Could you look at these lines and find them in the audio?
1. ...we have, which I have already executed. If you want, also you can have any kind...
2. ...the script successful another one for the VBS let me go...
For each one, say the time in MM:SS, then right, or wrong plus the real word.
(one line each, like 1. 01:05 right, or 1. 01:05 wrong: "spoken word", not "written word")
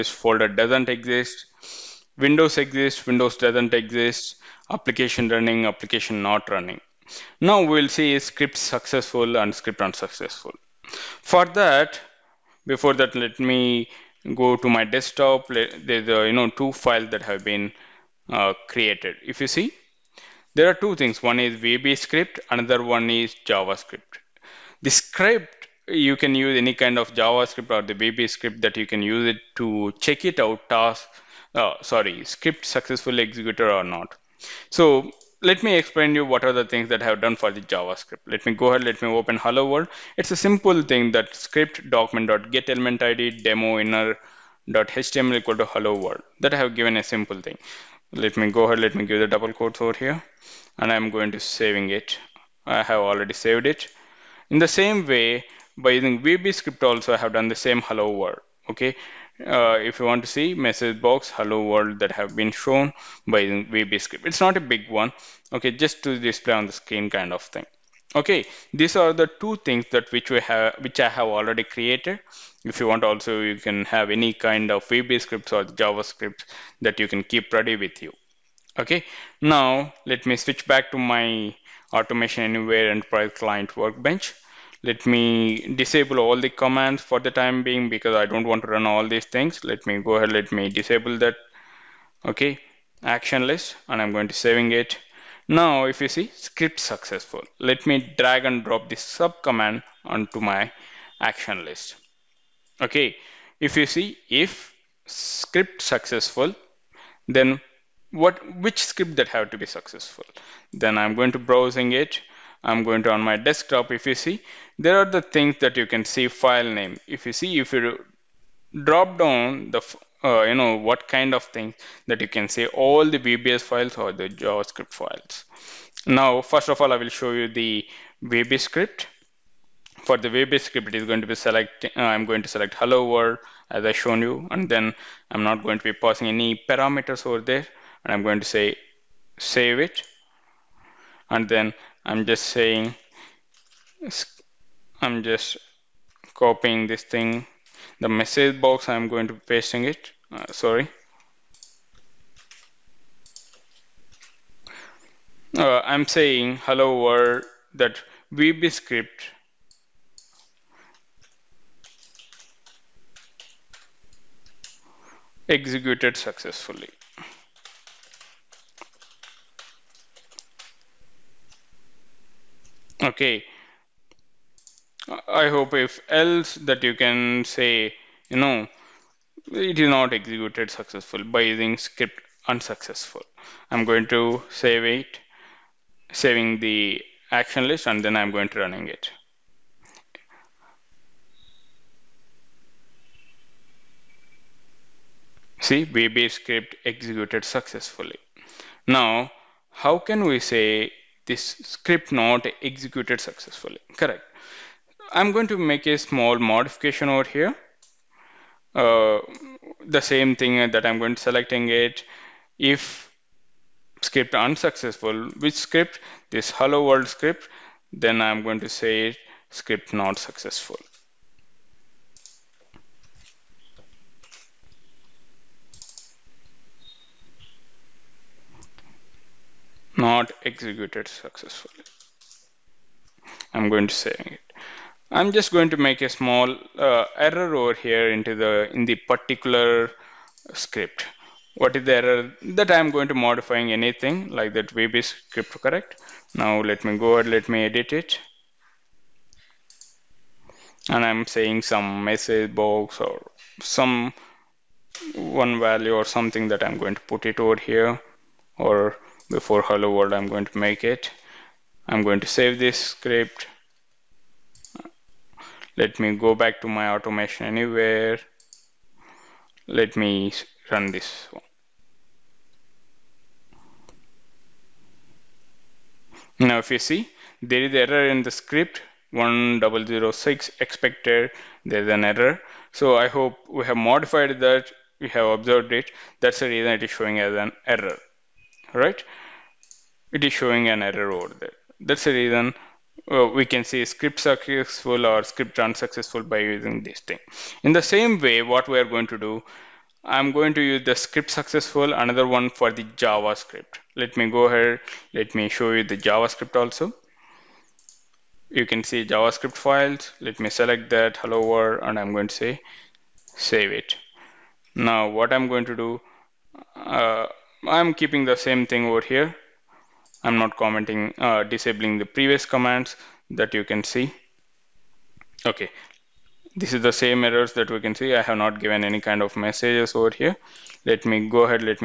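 1. 01:10 wrong: "created", not "executed"
2. 05:00 wrong: "JavaScript", not "VBS".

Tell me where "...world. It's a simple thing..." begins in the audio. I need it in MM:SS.
00:39.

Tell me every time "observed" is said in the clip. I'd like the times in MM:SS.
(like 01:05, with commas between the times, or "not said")
04:45.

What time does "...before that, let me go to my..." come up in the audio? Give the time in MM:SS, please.
00:12.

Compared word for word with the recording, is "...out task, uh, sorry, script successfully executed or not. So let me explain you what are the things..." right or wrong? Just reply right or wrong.
right.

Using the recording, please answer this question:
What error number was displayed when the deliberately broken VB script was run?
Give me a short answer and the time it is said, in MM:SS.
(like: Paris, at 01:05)
1006, at 04:39.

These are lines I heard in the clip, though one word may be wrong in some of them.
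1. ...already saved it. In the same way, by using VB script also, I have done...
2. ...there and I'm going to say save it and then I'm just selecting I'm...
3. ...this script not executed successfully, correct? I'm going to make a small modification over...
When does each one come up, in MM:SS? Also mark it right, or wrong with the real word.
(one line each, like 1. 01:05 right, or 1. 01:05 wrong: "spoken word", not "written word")
1. 00:52 right
2. 02:17 wrong: "saying", not "selecting"
3. 03:21 right.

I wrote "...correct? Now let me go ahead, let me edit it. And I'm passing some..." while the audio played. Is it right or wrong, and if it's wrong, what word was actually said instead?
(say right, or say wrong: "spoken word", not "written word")
wrong: "saying", not "passing".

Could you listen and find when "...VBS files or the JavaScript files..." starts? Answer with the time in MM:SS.
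02:03.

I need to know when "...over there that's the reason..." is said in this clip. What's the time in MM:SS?
04:51.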